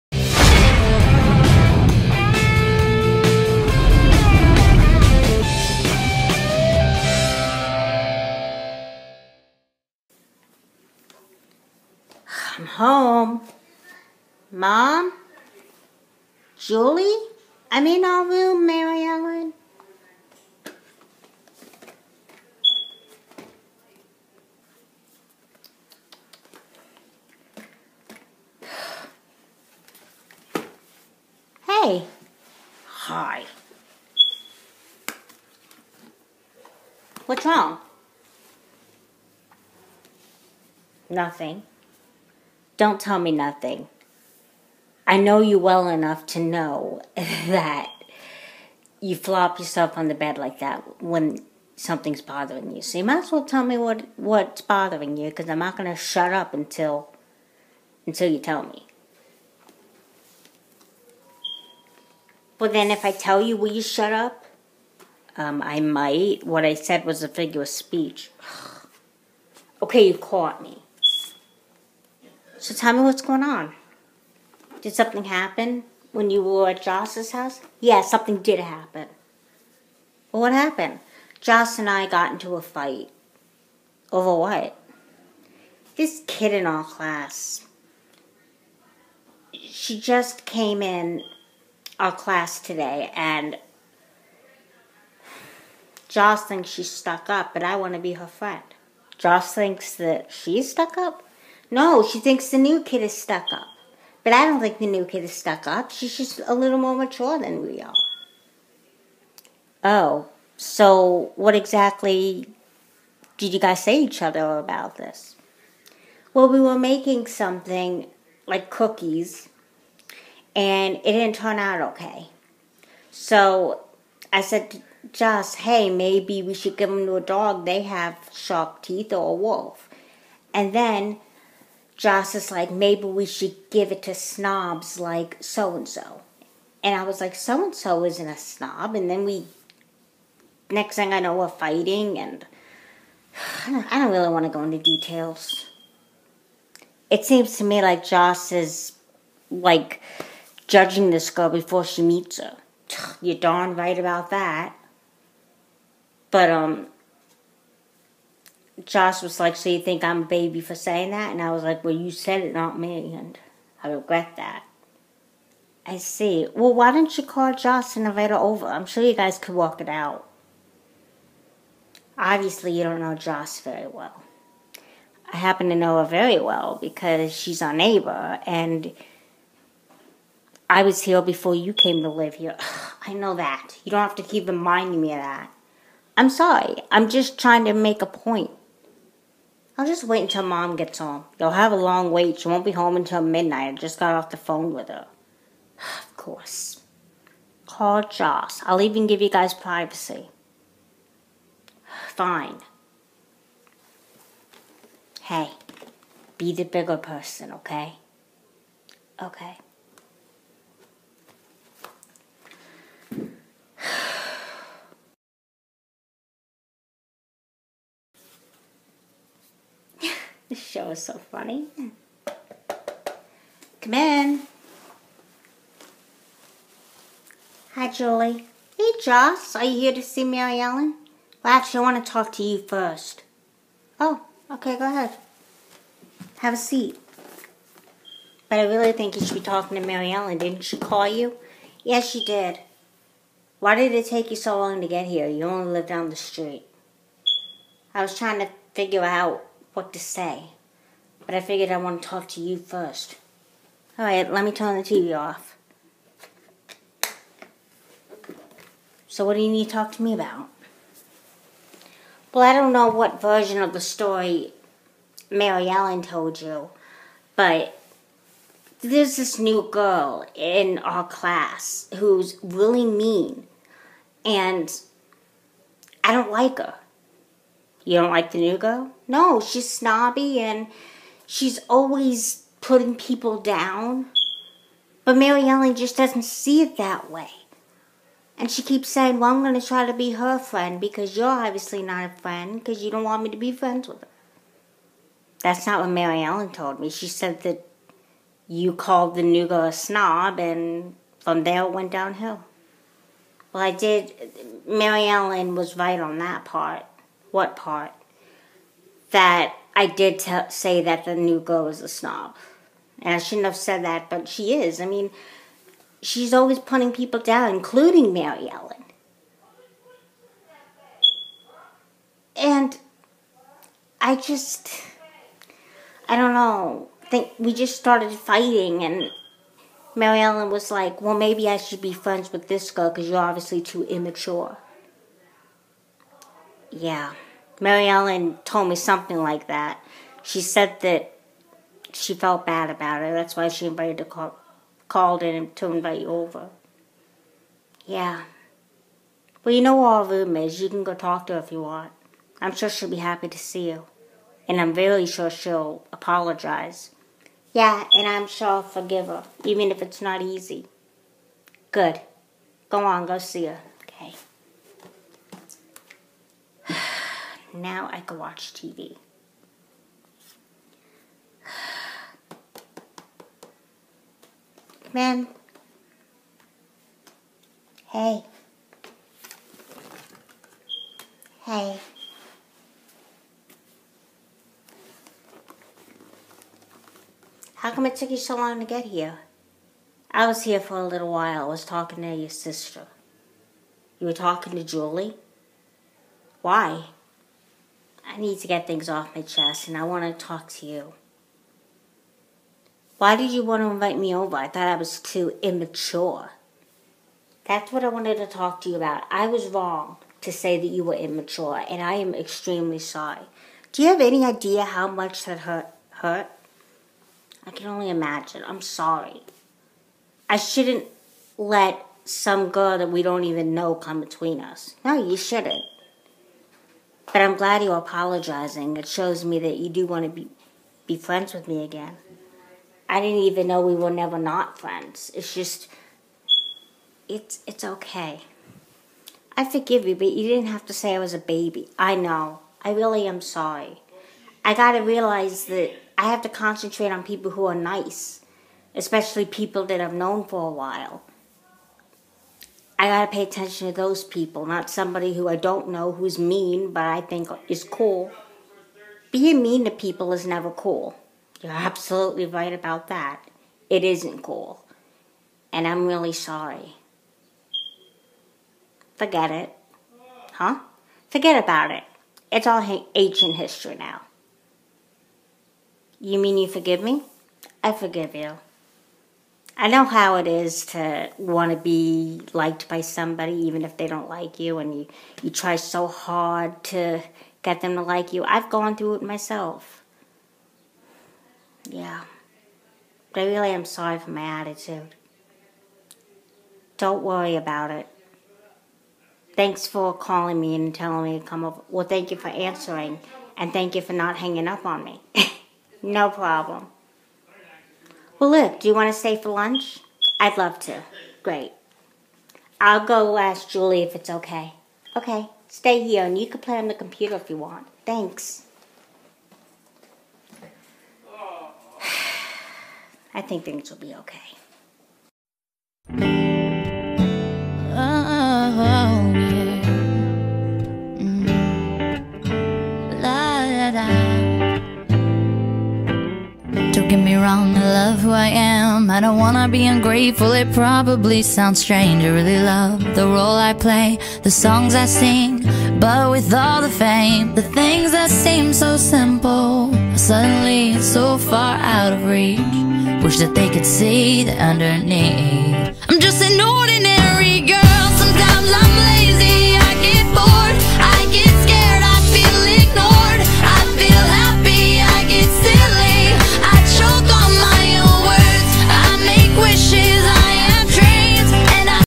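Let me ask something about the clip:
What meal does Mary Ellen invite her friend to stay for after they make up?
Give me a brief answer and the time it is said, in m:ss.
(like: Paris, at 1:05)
Lunch, at 8:29.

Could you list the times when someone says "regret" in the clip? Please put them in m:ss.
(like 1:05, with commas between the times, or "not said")
2:43.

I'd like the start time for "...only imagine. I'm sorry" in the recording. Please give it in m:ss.
6:57.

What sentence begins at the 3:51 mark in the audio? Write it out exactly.
Well, actually, I want to talk to you first.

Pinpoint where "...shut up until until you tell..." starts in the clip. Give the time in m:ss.
0:55.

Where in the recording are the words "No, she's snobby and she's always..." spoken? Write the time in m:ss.
4:39.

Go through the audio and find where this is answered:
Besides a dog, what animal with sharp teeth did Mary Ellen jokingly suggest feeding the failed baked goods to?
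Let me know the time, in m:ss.
2:09.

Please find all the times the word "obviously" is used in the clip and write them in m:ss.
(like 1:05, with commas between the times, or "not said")
2:52, 4:51, 5:33.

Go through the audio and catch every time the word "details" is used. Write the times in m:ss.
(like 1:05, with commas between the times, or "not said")
2:24.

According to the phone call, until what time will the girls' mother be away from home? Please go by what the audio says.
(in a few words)
Midnight.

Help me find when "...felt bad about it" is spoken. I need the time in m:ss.
5:42.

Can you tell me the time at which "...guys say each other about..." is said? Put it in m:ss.
1:53.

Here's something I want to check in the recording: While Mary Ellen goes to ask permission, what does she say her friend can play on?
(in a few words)
The computer.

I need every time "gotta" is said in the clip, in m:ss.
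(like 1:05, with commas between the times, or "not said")
7:24, 7:32.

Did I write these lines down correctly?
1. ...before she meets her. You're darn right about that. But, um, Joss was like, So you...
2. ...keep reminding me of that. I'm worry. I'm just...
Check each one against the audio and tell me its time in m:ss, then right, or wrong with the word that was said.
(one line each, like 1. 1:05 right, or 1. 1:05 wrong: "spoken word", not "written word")
1. 2:31 right
2. 3:04 wrong: "sorry", not "worry".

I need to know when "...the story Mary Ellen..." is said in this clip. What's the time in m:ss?
4:23.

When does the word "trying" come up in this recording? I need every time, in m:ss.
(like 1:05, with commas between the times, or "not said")
3:07, 4:08.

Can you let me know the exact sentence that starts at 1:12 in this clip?
So tell me what's going on.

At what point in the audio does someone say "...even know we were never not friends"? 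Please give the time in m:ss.
7:13.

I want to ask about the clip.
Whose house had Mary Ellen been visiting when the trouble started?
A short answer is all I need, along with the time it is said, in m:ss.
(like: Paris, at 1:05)
Joss's house, at 1:16.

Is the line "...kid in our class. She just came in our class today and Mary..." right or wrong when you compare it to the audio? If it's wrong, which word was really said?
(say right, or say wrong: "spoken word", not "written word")
wrong: "Joss", not "Mary".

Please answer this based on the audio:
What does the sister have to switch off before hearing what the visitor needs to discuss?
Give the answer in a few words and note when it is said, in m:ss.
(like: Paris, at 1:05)
The TV, at 4:14.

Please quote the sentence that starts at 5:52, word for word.
I'm sure she'll be happy to see you.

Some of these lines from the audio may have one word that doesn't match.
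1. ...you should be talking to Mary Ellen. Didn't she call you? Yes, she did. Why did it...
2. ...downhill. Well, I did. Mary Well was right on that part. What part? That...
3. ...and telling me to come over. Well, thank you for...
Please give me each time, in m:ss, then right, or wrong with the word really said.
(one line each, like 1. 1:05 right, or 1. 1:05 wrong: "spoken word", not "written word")
1. 3:59 right
2. 5:01 wrong: "Ellen", not "Well"
3. 8:20 right.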